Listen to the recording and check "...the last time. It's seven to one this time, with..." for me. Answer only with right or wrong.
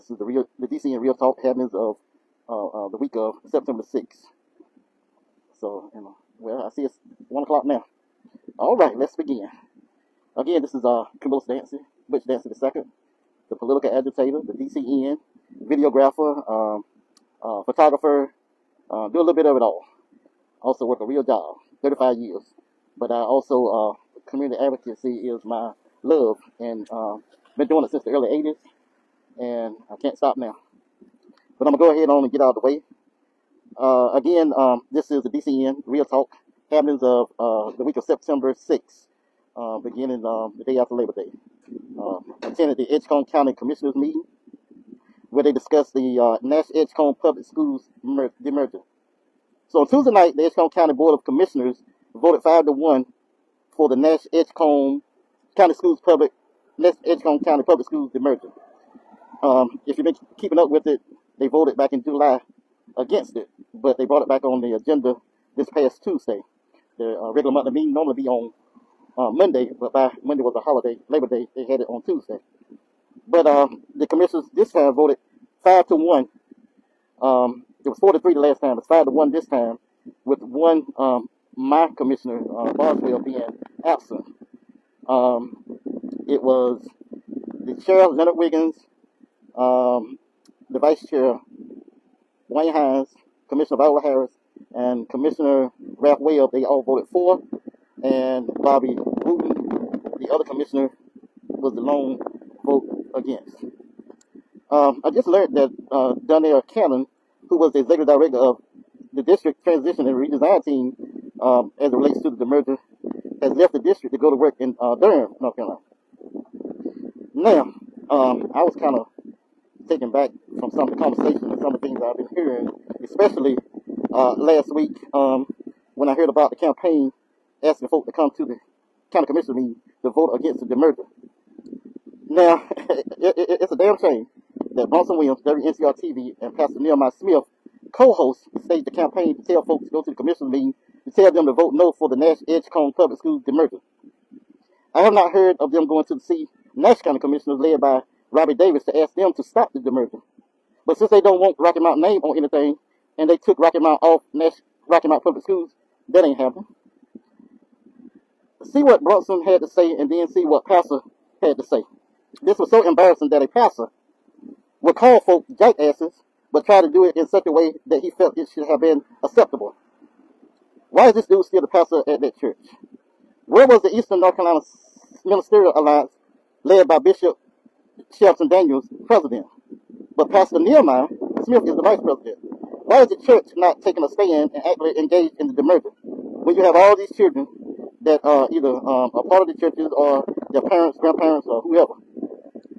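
wrong.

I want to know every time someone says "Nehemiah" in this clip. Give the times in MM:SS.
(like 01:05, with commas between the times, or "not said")
02:16, 03:00.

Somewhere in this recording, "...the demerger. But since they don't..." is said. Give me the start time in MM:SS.
02:29.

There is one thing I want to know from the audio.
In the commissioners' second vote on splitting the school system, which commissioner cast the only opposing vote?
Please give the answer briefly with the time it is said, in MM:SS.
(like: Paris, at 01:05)
Bobby Wooten, at 01:38.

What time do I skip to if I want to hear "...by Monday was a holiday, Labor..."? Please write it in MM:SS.
01:09.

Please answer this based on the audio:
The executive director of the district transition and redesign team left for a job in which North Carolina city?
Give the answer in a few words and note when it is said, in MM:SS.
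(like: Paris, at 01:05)
Durham, at 01:54.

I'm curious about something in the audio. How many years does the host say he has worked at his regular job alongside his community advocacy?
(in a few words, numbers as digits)
35.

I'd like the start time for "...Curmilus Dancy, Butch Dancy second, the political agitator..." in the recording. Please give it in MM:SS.
00:11.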